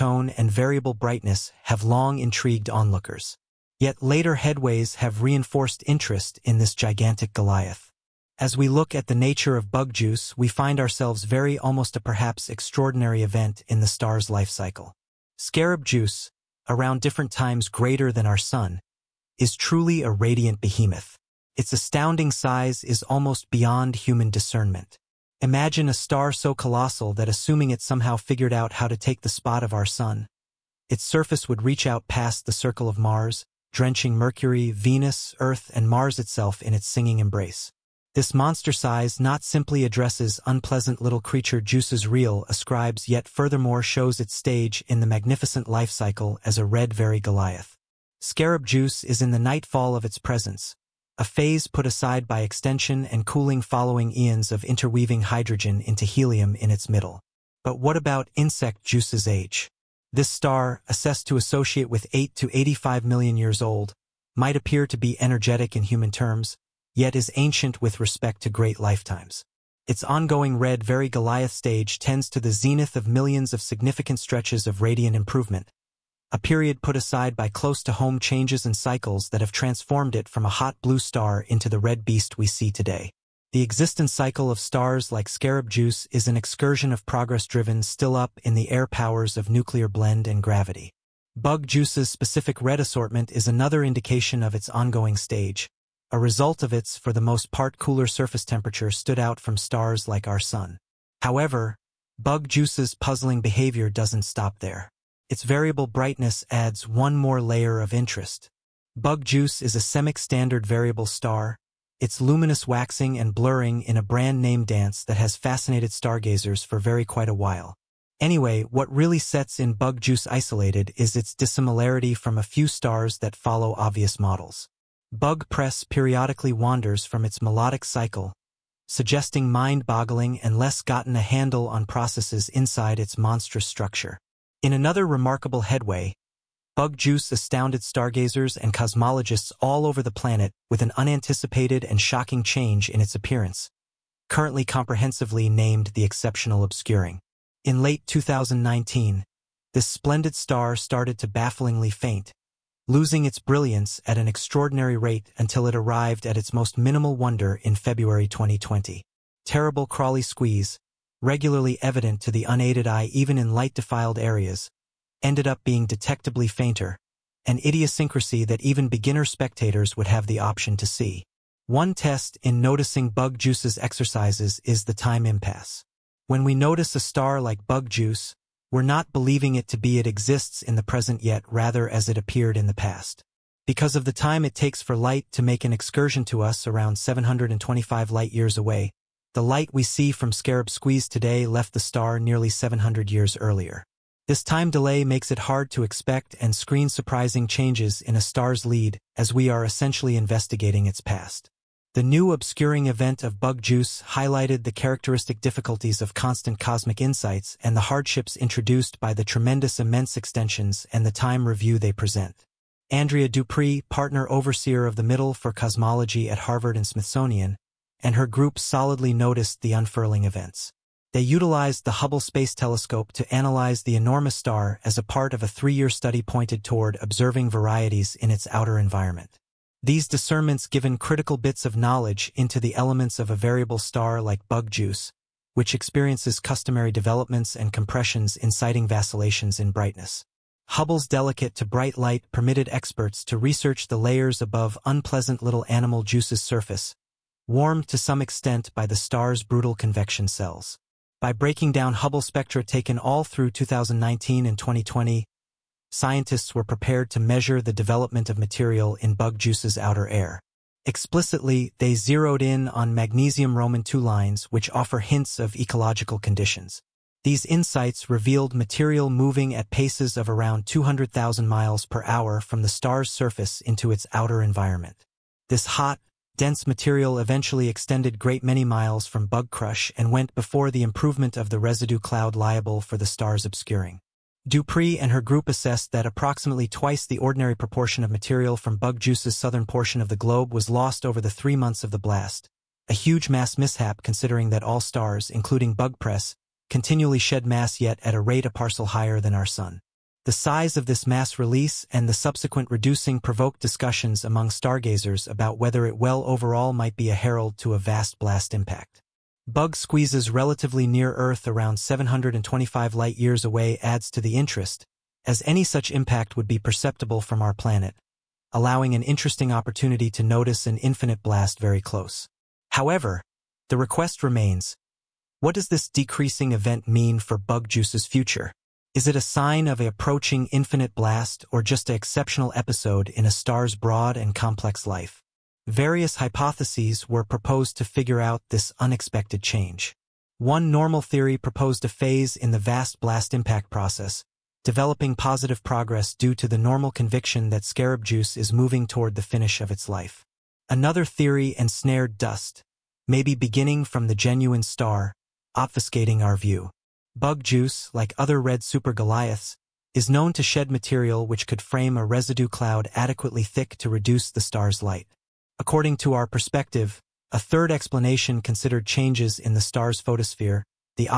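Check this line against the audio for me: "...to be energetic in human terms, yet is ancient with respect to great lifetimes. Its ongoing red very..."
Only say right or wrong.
right.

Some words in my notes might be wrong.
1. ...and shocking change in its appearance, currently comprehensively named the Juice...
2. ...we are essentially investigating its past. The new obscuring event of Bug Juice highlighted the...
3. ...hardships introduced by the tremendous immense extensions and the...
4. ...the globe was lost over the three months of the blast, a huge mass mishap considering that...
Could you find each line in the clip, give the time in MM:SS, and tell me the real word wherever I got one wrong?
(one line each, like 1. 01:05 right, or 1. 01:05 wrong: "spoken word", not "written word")
1. 02:21 wrong: "Exceptional", not "Juice"
2. 03:19 right
3. 03:27 right
4. 04:50 right.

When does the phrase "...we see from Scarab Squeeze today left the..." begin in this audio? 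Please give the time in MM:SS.
03:09.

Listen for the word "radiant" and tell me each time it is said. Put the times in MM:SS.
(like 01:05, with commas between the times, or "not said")
00:20, 01:14.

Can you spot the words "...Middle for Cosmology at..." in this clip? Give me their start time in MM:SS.
03:35.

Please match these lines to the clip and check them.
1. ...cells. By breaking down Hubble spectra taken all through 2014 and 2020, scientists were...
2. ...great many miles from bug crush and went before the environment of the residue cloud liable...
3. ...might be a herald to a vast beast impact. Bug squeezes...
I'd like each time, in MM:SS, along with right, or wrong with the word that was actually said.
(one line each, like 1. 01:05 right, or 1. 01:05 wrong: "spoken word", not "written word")
1. 04:10 wrong: "2019", not "2014"
2. 04:38 wrong: "improvement", not "environment"
3. 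05:06 wrong: "blast", not "beast".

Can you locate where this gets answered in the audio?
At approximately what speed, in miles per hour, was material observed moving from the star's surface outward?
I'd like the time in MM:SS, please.
04:30.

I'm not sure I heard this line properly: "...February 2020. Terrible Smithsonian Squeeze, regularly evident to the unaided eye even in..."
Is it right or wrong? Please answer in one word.
wrong.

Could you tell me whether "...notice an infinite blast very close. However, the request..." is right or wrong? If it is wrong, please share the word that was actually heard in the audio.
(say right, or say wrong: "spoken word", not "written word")
right.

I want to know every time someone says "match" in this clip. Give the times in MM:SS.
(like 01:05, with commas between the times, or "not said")
not said.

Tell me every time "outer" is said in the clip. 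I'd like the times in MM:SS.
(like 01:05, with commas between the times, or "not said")
03:48, 04:19, 04:34.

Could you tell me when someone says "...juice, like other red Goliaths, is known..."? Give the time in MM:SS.
05:57.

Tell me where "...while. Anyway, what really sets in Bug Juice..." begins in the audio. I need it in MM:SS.
01:57.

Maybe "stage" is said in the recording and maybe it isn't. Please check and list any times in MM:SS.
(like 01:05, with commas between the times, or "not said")
00:44, 01:11, 01:35.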